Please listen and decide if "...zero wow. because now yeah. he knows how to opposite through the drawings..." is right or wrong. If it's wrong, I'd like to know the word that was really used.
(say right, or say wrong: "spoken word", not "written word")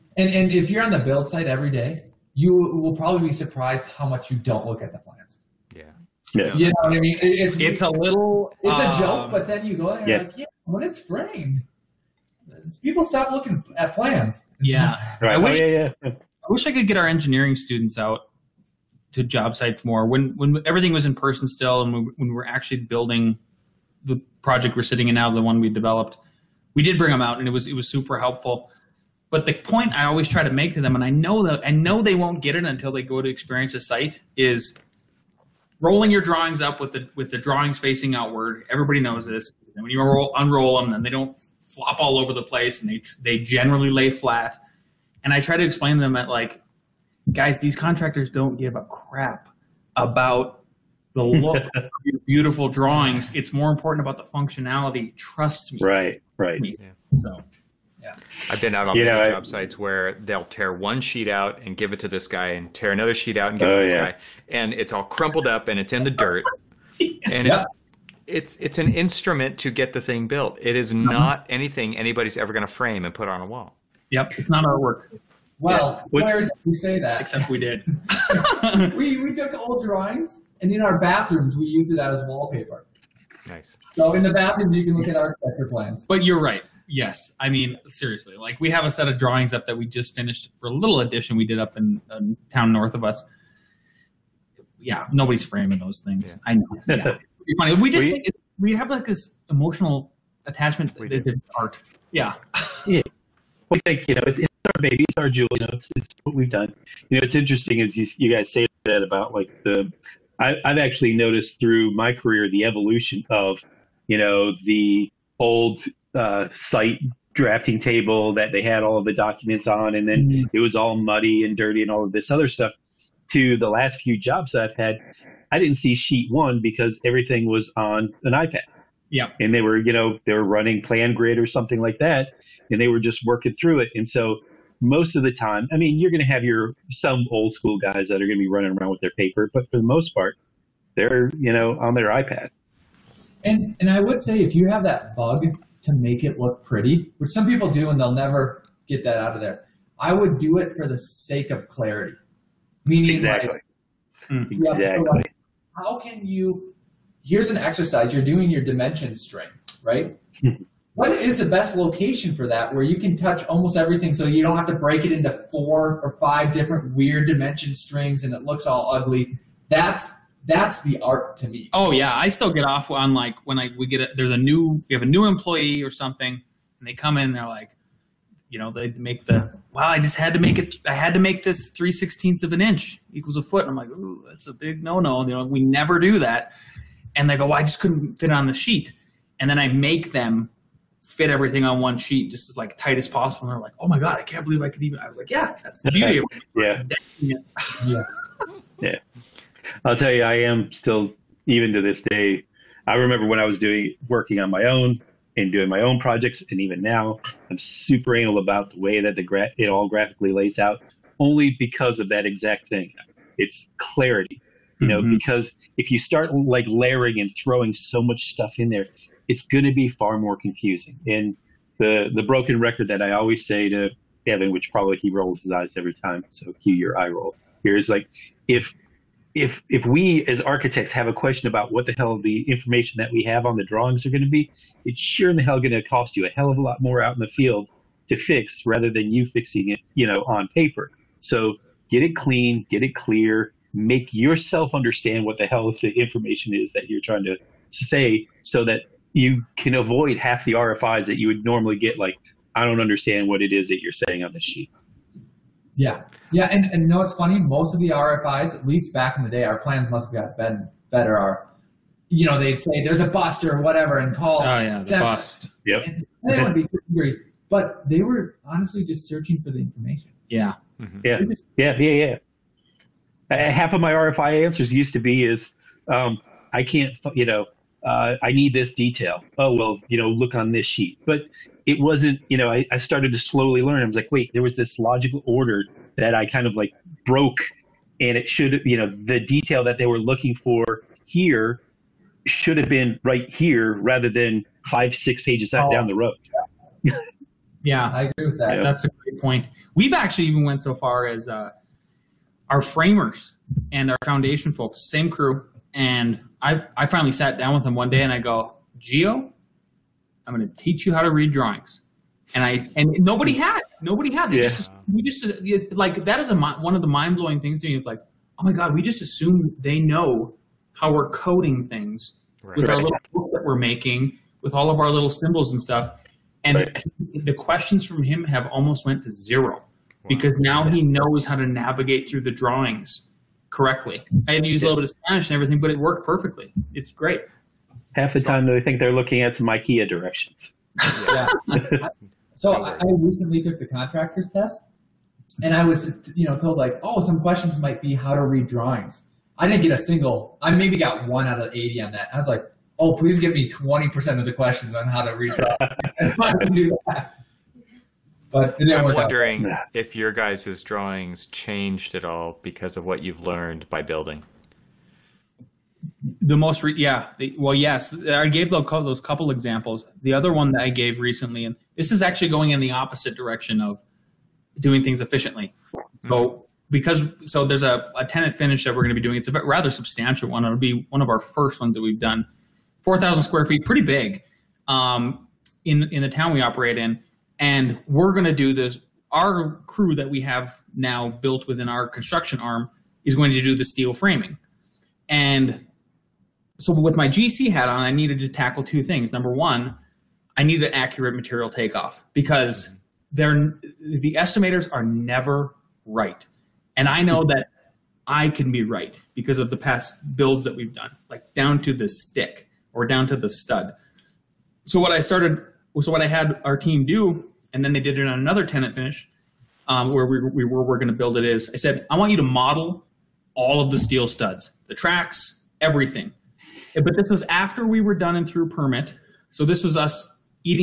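wrong: "navigate", not "opposite".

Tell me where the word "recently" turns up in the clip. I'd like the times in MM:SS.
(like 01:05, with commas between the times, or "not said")
05:42, 06:10.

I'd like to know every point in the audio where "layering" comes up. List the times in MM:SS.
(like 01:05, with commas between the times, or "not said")
03:36.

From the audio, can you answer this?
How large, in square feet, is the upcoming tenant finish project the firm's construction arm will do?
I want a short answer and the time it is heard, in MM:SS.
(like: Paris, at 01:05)
4,000 square feet, at 06:22.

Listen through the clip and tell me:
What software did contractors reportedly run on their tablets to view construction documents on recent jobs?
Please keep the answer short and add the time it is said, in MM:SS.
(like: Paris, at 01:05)
PlanGrid, at 02:10.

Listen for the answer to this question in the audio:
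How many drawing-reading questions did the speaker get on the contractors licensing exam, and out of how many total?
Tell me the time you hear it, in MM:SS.
05:51.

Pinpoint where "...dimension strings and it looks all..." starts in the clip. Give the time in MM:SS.
02:47.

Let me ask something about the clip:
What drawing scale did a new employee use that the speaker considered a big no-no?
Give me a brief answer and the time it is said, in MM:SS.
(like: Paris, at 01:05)
3/16 inch equals a foot, at 03:01.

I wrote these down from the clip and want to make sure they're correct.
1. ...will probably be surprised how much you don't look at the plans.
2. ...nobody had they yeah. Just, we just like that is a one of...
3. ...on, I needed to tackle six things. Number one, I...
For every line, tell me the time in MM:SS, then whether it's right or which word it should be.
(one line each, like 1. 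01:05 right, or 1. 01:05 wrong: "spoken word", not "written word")
1. 00:02 right
2. 05:13 right
3. 06:37 wrong: "two", not "six".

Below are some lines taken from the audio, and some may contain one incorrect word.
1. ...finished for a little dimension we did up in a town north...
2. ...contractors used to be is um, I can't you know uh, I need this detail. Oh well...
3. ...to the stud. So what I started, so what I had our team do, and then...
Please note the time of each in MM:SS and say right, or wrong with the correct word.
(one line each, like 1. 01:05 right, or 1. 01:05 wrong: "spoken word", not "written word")
1. 01:30 wrong: "edition", not "dimension"
2. 04:34 wrong: "answers", not "contractors"
3. 06:53 right.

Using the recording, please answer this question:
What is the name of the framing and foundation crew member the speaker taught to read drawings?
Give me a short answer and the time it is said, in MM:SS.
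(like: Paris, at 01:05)
Geo, at 05:08.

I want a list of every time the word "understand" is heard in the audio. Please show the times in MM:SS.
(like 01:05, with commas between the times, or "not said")
04:04, 04:12.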